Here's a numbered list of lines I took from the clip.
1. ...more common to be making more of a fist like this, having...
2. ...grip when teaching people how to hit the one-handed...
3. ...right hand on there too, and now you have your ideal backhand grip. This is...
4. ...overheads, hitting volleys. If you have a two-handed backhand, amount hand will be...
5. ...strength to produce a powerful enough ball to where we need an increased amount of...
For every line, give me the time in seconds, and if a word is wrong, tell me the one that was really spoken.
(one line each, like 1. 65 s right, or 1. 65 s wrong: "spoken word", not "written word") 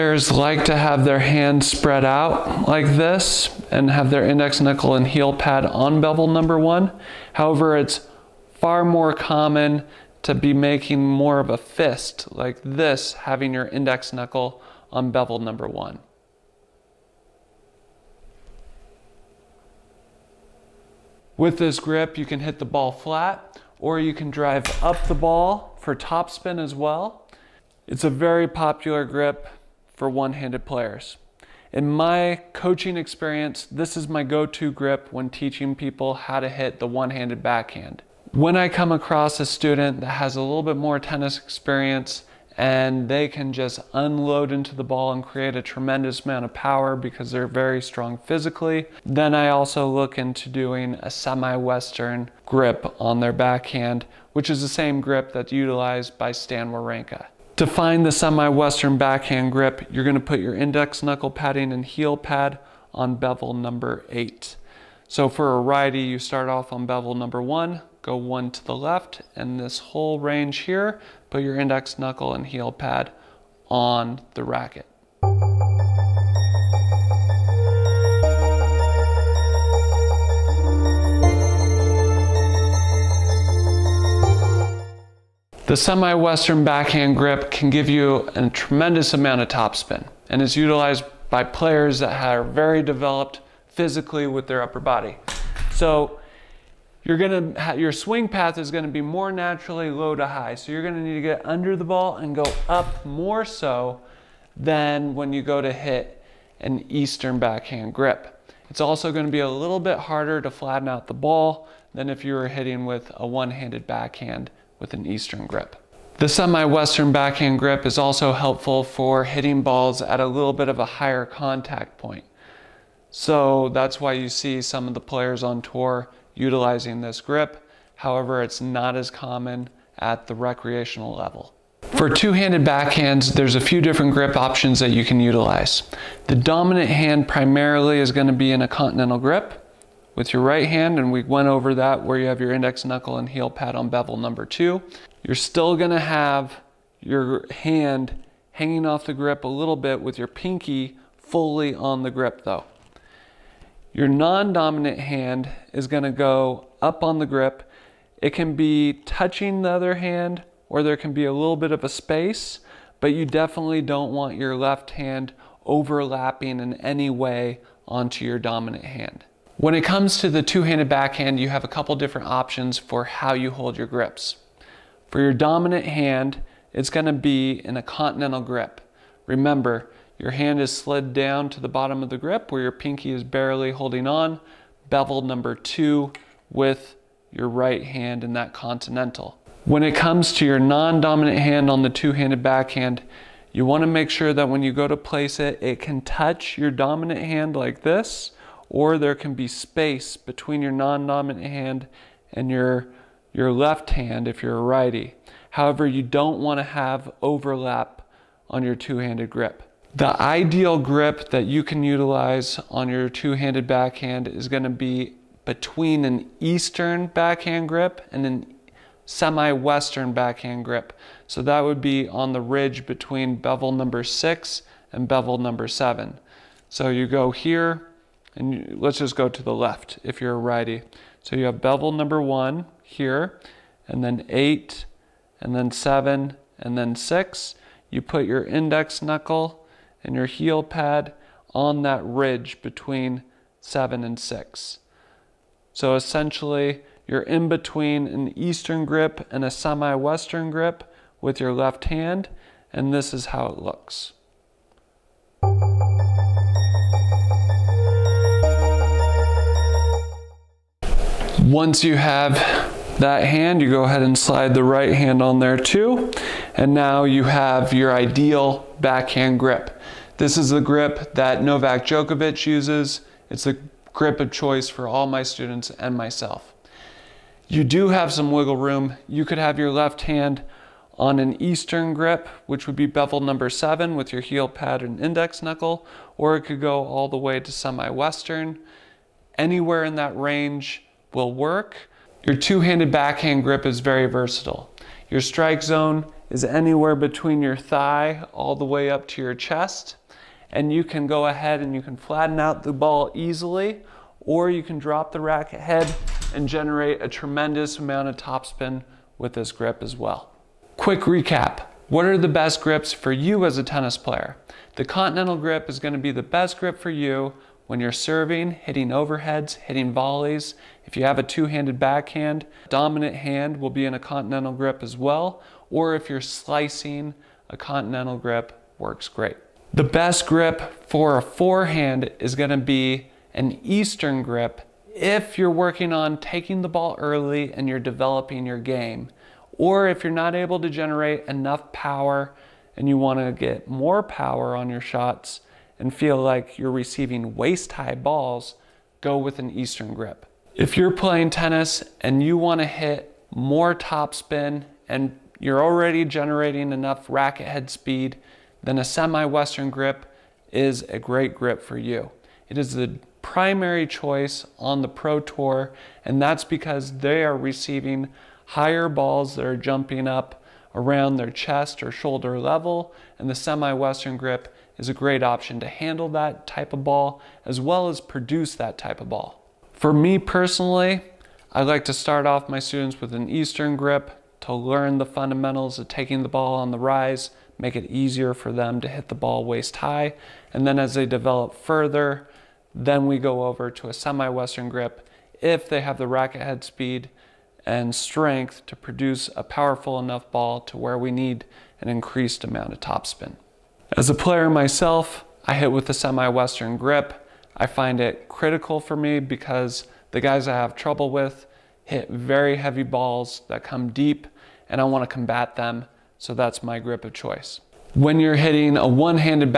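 1. 8 s right
2. 34 s right
3. 264 s right
4. 318 s wrong: "dominant", not "amount"
5. 397 s right.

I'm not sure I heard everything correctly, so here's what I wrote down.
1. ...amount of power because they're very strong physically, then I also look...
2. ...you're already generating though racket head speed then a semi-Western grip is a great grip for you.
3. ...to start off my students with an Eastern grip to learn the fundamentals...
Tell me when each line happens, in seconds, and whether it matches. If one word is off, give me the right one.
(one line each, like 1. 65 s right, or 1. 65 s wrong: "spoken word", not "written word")
1. 46 s right
2. 355 s wrong: "enough", not "though"
3. 381 s right.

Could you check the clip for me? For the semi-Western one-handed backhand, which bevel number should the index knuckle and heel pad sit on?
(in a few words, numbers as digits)
8.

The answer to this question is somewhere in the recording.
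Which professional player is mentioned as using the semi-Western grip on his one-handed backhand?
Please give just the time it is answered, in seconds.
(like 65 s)
56 s.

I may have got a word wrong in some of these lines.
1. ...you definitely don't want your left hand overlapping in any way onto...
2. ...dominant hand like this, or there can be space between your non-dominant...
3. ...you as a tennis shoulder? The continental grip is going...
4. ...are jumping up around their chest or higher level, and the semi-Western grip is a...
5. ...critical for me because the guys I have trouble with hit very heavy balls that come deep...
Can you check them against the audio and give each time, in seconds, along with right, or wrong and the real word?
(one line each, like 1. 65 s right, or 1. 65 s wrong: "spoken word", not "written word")
1. 163 s right
2. 196 s right
3. 313 s wrong: "player", not "shoulder"
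4. 369 s wrong: "shoulder", not "higher"
5. 408 s right.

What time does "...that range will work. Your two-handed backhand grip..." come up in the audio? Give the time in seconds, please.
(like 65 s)
289 s.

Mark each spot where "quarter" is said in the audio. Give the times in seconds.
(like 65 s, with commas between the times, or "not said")
not said.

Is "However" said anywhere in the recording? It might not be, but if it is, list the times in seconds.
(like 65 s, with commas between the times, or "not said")
7 s, 127 s, 205 s.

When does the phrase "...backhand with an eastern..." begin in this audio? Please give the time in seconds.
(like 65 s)
113 s.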